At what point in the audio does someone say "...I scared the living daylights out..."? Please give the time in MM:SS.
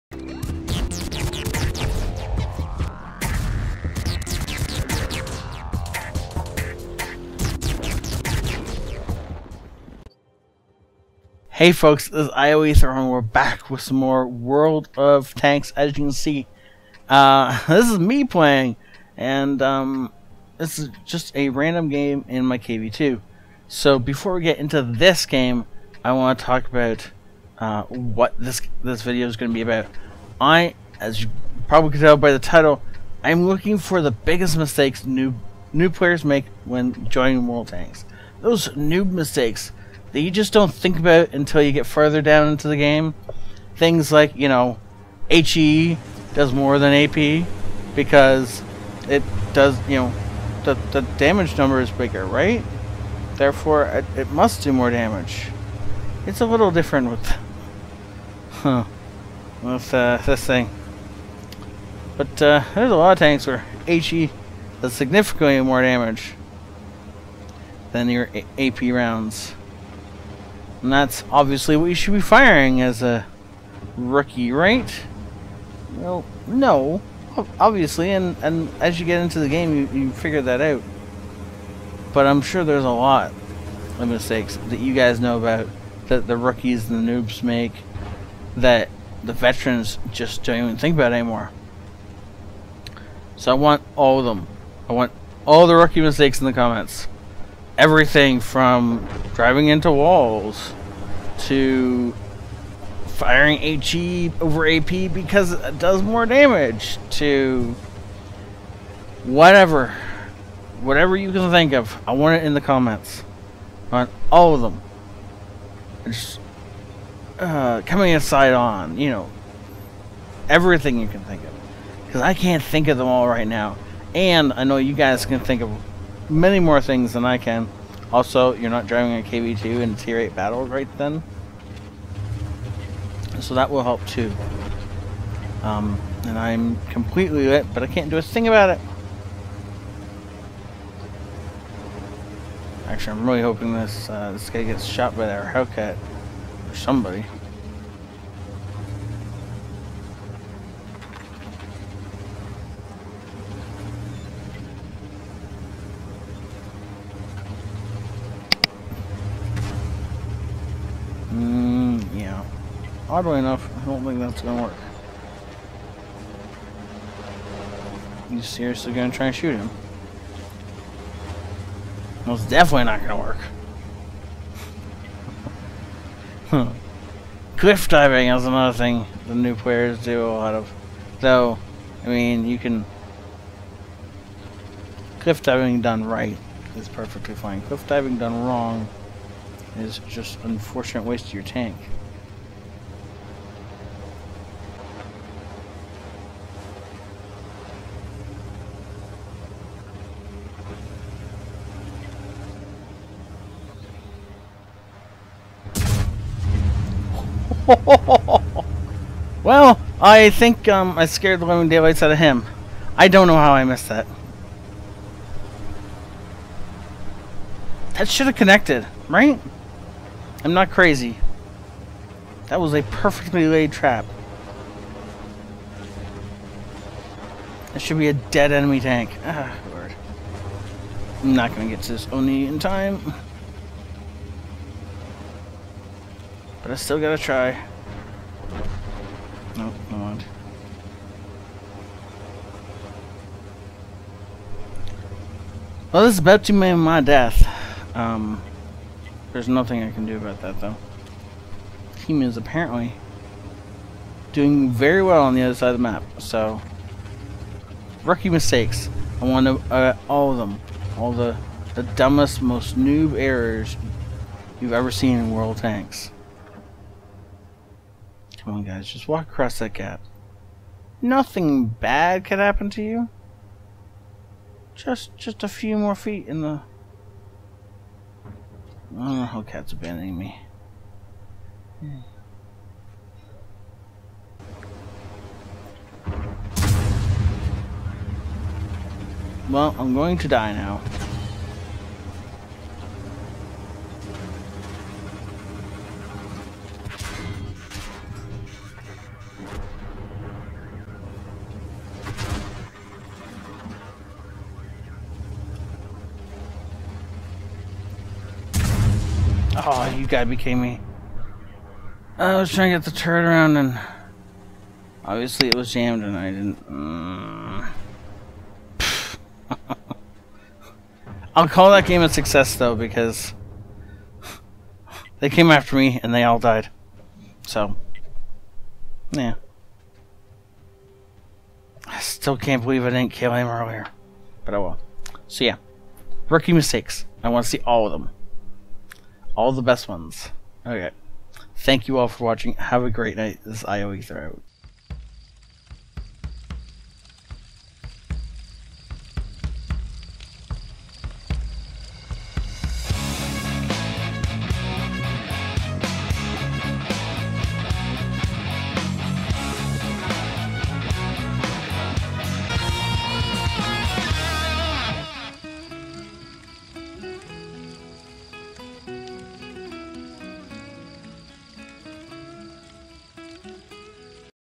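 03:30.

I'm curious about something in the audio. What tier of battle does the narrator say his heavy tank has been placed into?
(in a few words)
tier 8.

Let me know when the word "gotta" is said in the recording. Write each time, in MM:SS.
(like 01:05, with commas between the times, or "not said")
03:56, 05:10.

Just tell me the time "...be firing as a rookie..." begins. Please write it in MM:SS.
01:12.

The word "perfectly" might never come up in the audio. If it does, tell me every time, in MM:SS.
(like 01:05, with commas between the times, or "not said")
03:06, 03:42.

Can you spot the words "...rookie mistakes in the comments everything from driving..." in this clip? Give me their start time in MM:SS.
01:35.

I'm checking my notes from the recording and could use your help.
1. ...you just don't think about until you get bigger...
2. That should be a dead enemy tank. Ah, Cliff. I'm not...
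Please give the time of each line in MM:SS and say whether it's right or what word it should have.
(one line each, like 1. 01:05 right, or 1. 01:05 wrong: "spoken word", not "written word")
1. 00:40 wrong: "further", not "bigger"
2. 03:47 wrong: "Lord", not "Cliff".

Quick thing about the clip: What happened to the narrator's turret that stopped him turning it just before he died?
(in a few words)
jammed.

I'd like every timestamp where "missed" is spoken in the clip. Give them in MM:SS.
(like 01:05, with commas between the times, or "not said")
03:33.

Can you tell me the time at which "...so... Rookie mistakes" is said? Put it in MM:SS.
04:16.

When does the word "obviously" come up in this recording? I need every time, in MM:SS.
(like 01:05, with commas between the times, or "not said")
01:11, 01:17, 05:15.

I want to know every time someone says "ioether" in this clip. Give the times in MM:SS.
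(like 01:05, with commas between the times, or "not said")
00:12, 05:43.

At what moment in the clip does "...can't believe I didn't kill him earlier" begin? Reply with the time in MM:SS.
05:32.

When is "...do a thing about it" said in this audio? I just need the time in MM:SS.
02:18.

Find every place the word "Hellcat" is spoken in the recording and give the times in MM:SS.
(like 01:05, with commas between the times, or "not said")
02:25, 04:39.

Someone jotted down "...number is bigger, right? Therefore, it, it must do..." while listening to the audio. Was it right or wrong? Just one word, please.
right.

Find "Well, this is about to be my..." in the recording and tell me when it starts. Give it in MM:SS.
04:05.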